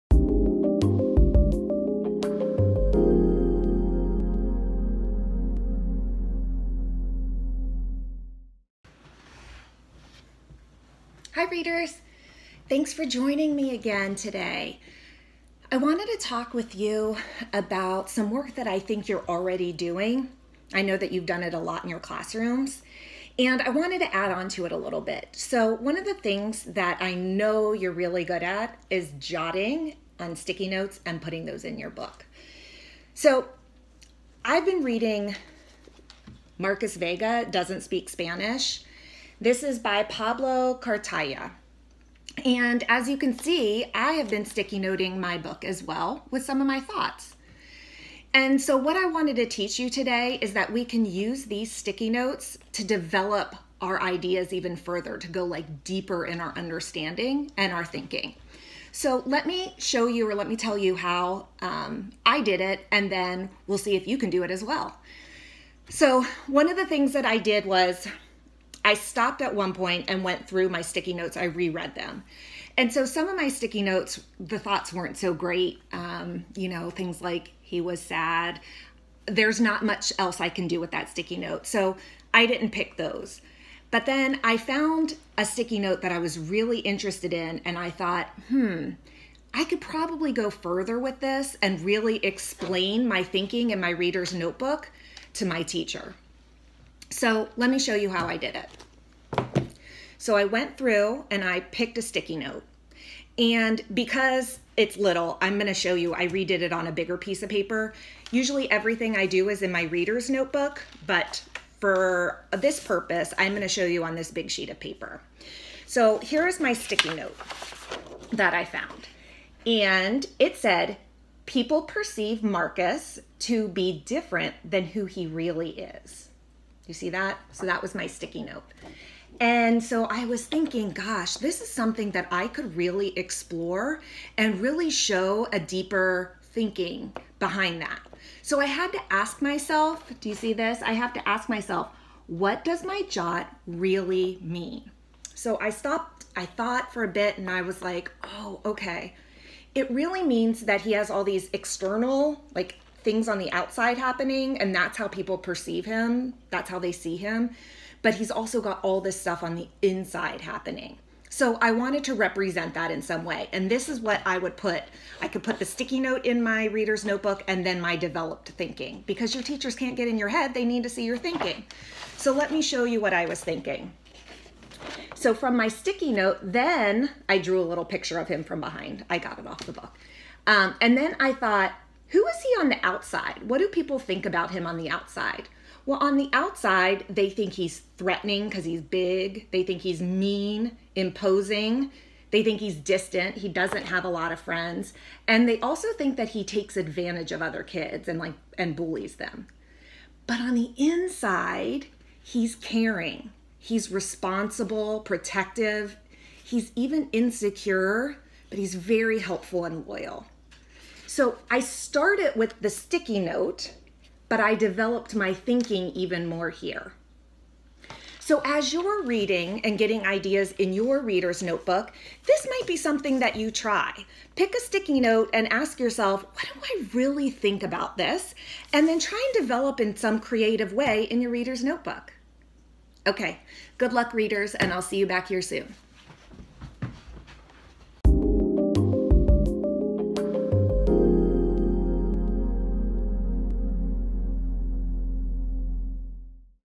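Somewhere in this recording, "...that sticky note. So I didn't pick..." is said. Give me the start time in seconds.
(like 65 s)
80 s.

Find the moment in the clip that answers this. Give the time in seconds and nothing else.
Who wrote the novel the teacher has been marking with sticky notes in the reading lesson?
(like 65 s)
40 s.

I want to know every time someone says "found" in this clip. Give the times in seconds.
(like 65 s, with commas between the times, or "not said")
84 s, 118 s.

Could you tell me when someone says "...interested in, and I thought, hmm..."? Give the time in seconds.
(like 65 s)
86 s.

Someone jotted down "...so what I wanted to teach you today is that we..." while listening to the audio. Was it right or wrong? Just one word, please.
right.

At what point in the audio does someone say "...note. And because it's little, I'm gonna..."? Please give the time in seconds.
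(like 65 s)
102 s.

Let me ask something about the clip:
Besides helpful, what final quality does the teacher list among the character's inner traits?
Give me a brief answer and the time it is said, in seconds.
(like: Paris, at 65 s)
Loyal, at 209 s.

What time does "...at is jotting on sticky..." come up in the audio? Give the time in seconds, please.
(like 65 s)
28 s.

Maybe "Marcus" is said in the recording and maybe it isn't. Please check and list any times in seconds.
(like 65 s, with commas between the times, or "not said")
36 s, 122 s.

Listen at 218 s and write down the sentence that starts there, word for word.
So as you're reading and getting ideas in your reader's notebook, this might be something that you try.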